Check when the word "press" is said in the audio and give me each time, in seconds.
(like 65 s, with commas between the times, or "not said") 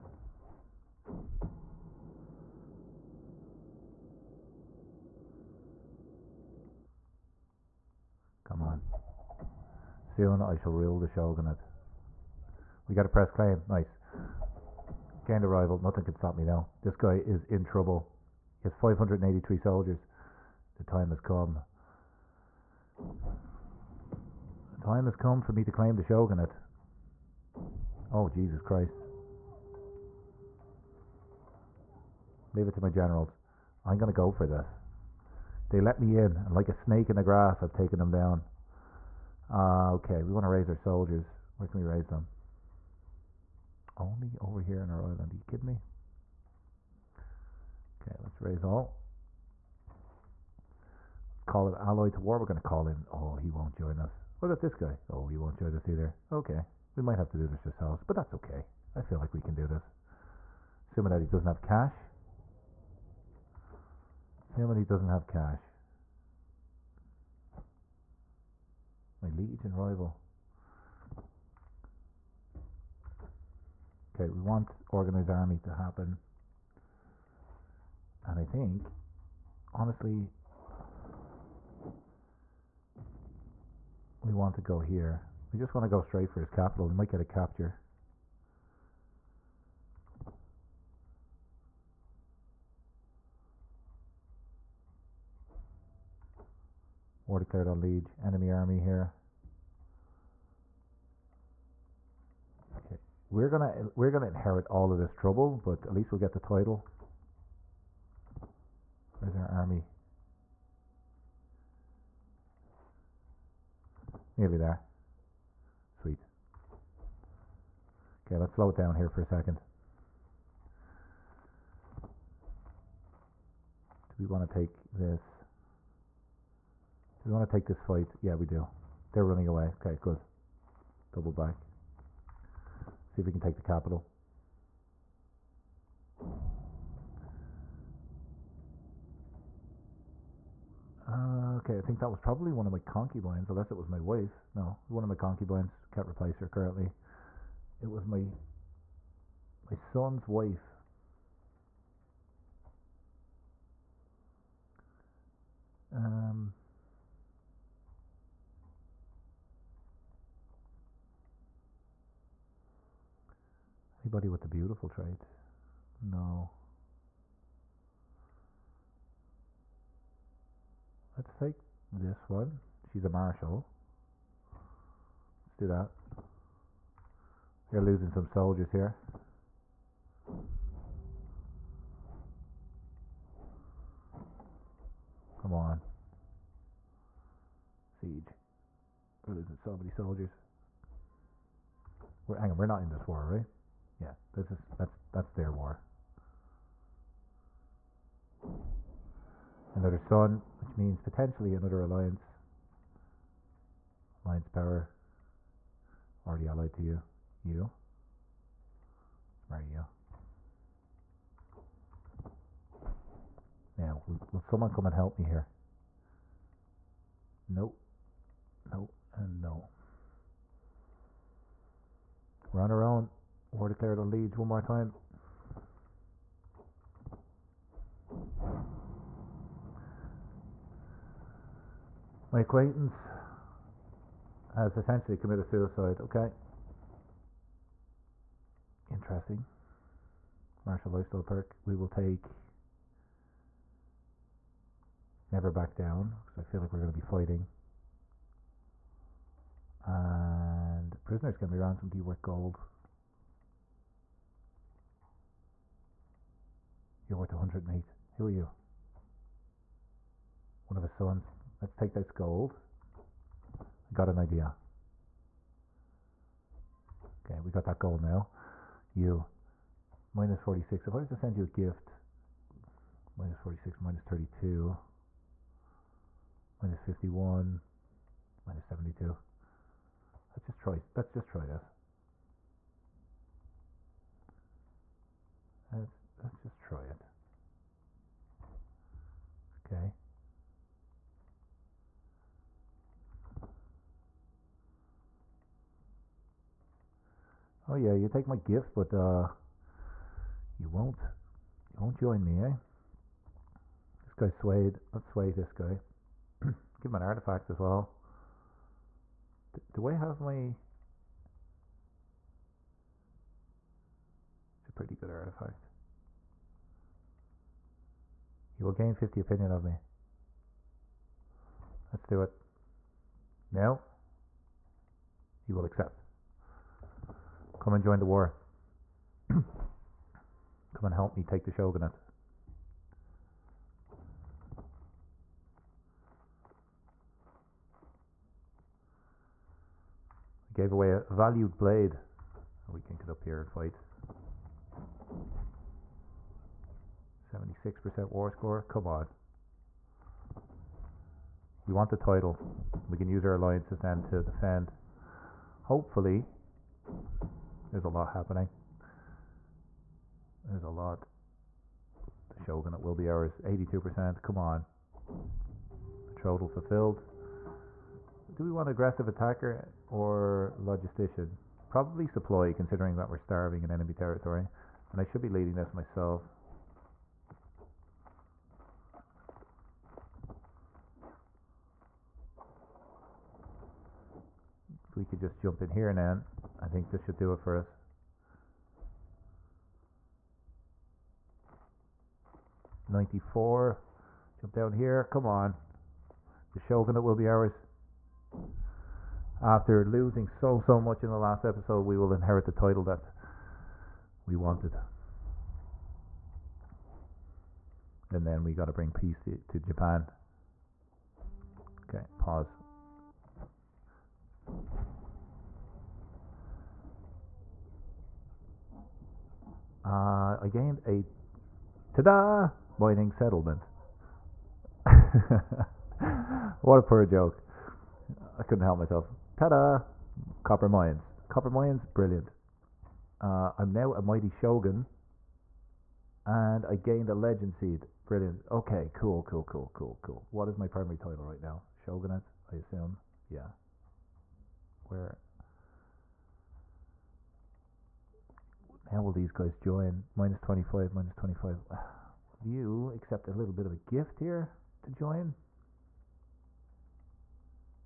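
13 s.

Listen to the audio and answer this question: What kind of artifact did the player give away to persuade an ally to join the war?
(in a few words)
A valued blade.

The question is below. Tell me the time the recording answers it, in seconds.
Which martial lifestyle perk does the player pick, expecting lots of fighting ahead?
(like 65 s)
245 s.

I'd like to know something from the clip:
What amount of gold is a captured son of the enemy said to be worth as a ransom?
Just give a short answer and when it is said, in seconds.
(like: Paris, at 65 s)
108, at 257 s.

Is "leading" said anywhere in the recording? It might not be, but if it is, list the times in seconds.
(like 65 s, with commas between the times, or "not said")
375 s.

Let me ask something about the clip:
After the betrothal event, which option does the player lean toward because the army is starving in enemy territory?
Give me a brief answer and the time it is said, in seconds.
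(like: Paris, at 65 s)
Logistician, at 370 s.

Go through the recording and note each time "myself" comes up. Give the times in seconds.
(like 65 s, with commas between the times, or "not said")
375 s, 428 s.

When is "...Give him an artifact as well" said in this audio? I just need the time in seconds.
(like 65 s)
306 s.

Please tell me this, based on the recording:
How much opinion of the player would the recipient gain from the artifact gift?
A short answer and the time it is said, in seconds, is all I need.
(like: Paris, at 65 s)
50, at 318 s.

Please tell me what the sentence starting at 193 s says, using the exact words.
Yeah, this is that's that's their war.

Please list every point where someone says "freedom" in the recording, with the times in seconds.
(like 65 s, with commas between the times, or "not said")
not said.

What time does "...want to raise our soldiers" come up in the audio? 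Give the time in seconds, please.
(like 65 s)
40 s.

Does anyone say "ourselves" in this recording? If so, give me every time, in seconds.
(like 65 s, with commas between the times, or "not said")
57 s.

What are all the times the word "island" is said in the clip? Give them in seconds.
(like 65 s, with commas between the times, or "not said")
45 s.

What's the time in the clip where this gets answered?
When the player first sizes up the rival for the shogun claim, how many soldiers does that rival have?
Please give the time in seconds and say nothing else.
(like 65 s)
18 s.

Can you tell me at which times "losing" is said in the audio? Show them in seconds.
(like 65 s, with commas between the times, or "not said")
177 s, 189 s, 399 s.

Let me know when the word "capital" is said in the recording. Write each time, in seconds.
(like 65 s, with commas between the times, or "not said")
86 s, 133 s.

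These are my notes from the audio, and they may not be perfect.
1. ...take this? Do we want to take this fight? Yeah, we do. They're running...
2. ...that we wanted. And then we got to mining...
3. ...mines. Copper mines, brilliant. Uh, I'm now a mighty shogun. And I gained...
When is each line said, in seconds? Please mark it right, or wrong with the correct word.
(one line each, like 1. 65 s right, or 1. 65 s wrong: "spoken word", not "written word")
1. 124 s right
2. 402 s wrong: "bring", not "mining"
3. 430 s right.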